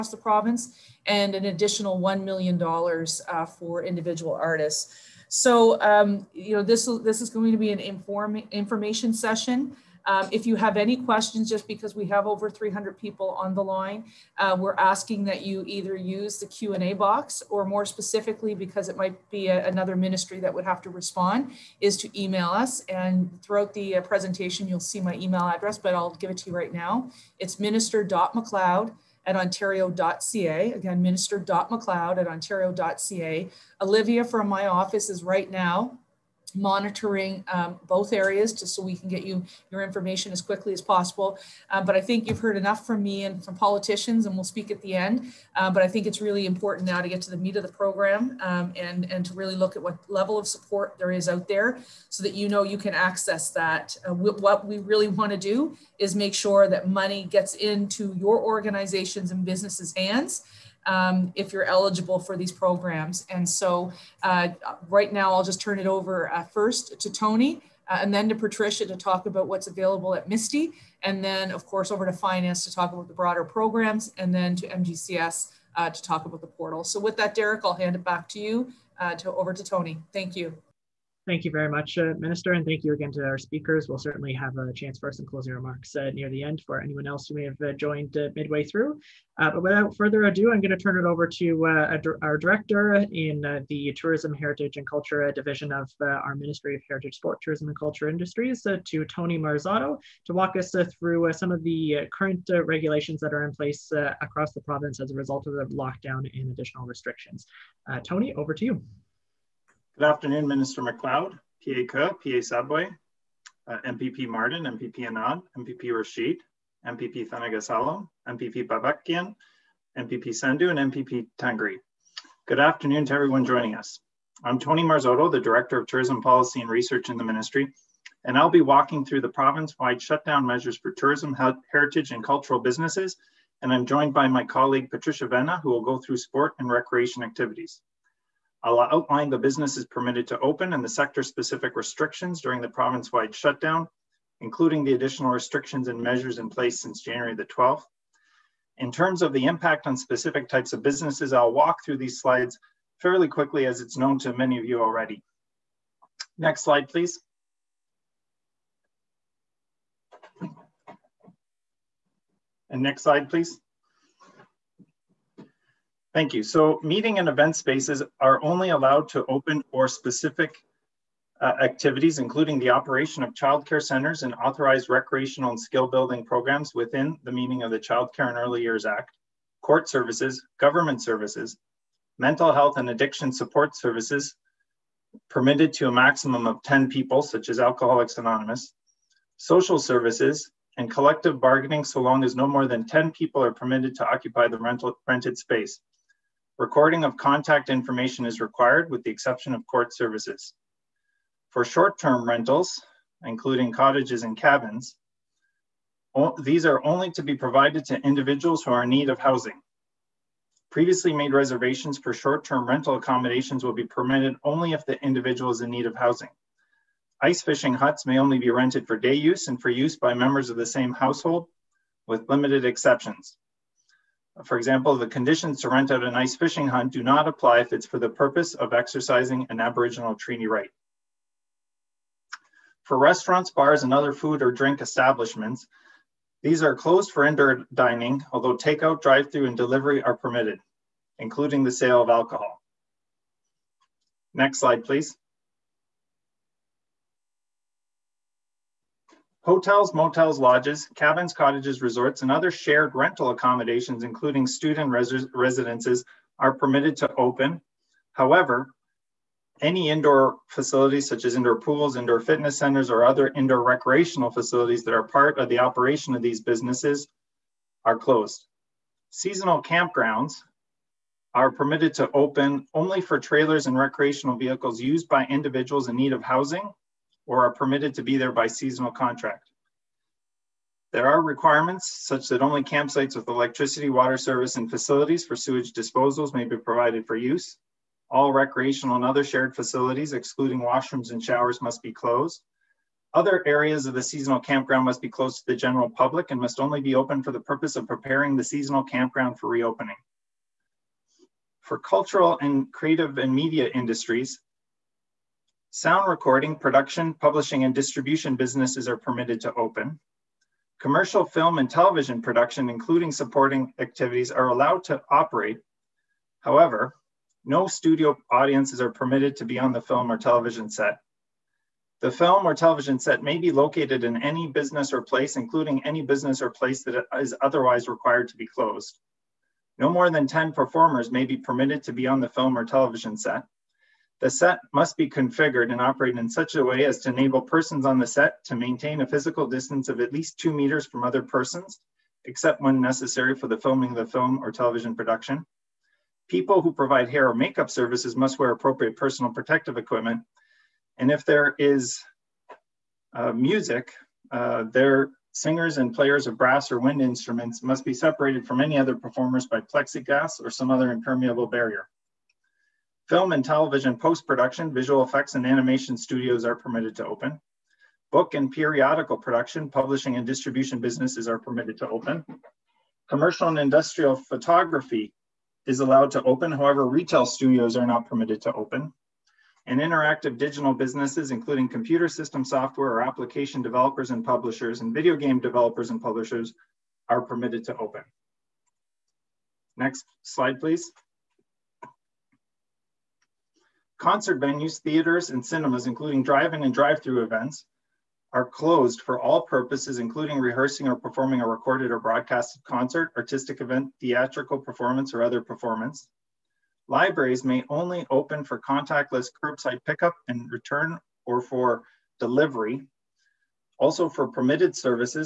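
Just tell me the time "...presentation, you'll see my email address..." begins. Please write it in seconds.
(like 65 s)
24 s.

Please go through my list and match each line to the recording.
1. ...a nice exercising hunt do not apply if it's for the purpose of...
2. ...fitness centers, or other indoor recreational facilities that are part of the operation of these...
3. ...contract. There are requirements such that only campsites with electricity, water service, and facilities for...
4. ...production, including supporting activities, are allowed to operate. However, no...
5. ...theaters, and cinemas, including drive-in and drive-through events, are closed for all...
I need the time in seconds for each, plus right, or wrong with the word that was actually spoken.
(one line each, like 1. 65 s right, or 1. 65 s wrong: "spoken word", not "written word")
1. 226 s wrong: "fishing", not "exercising"
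2. 262 s right
3. 278 s right
4. 312 s right
5. 394 s right.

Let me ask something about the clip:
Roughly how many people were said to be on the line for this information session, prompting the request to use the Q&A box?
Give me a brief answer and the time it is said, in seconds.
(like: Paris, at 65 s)
over 300, at 12 s.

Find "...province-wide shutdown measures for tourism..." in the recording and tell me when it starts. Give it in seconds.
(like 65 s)
129 s.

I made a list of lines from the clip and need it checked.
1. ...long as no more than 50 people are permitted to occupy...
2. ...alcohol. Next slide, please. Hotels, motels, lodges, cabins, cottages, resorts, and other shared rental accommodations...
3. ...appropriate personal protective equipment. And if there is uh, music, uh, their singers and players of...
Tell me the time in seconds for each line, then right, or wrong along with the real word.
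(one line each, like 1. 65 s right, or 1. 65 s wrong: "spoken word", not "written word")
1. 192 s wrong: "10", not "50"
2. 242 s right
3. 348 s right.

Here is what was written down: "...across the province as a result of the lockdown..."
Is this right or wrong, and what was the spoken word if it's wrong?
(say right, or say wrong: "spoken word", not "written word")
right.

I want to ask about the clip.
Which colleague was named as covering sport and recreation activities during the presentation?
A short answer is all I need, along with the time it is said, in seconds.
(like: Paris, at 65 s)
Patricia Venna, at 134 s.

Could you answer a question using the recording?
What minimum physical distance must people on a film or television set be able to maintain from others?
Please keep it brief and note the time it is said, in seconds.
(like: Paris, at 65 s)
2 meters, at 340 s.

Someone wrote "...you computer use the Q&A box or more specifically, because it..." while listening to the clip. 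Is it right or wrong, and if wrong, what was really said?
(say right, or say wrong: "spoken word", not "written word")
wrong: "either", not "computer".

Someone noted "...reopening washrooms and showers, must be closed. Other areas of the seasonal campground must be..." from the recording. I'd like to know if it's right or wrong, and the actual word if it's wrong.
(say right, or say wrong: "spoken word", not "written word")
wrong: "excluding", not "reopening".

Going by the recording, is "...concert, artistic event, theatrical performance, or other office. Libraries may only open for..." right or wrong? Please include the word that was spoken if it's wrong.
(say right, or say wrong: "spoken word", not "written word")
wrong: "performance", not "office".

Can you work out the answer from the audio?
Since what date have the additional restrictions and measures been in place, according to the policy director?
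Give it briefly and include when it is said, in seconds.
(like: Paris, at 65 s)
January 12, at 147 s.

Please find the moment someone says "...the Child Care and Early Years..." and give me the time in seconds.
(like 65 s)
177 s.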